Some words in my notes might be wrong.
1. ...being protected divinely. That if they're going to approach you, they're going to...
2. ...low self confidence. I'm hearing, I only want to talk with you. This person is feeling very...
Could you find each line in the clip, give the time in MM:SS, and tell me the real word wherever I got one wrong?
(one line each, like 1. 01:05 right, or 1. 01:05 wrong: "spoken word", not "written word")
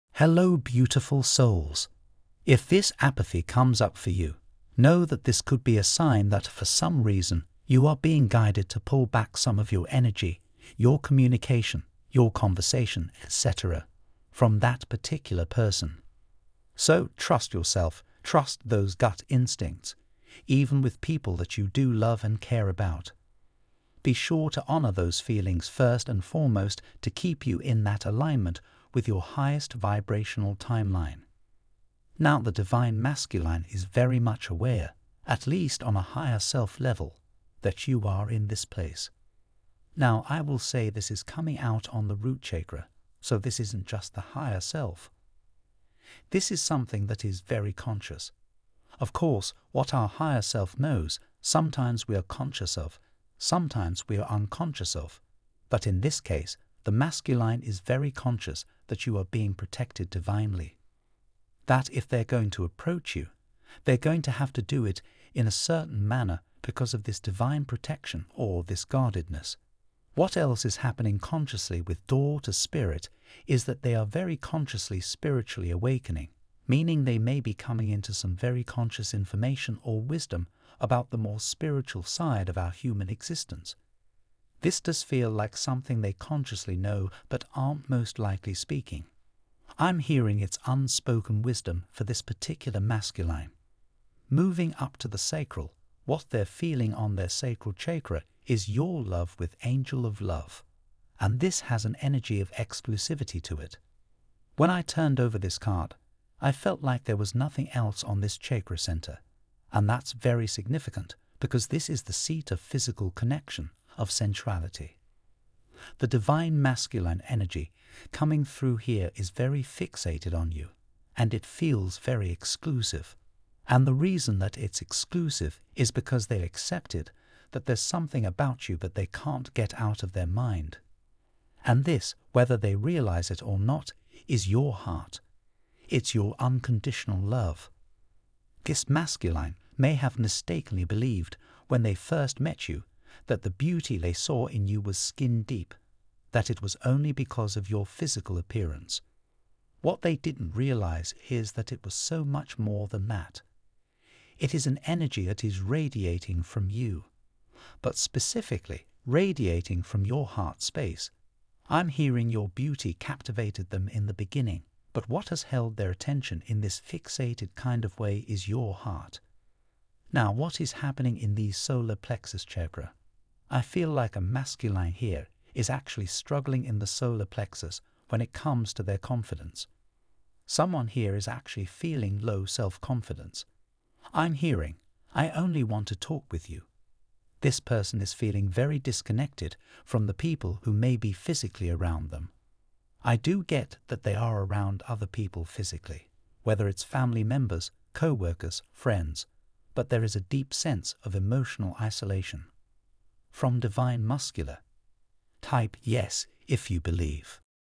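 1. 00:59 right
2. 03:02 right.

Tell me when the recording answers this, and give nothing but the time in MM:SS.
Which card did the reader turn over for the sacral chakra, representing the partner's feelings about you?
01:39.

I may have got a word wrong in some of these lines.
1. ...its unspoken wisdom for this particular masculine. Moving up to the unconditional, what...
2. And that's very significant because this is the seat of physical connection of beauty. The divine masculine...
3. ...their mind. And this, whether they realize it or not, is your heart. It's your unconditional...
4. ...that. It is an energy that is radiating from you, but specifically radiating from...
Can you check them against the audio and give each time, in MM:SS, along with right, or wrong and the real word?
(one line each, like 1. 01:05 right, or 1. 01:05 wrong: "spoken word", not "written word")
1. 01:30 wrong: "sacral", not "unconditional"
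2. 01:49 wrong: "centrality", not "beauty"
3. 02:10 right
4. 02:33 right.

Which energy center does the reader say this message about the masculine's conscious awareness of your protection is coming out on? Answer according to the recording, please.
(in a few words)
Root chakra.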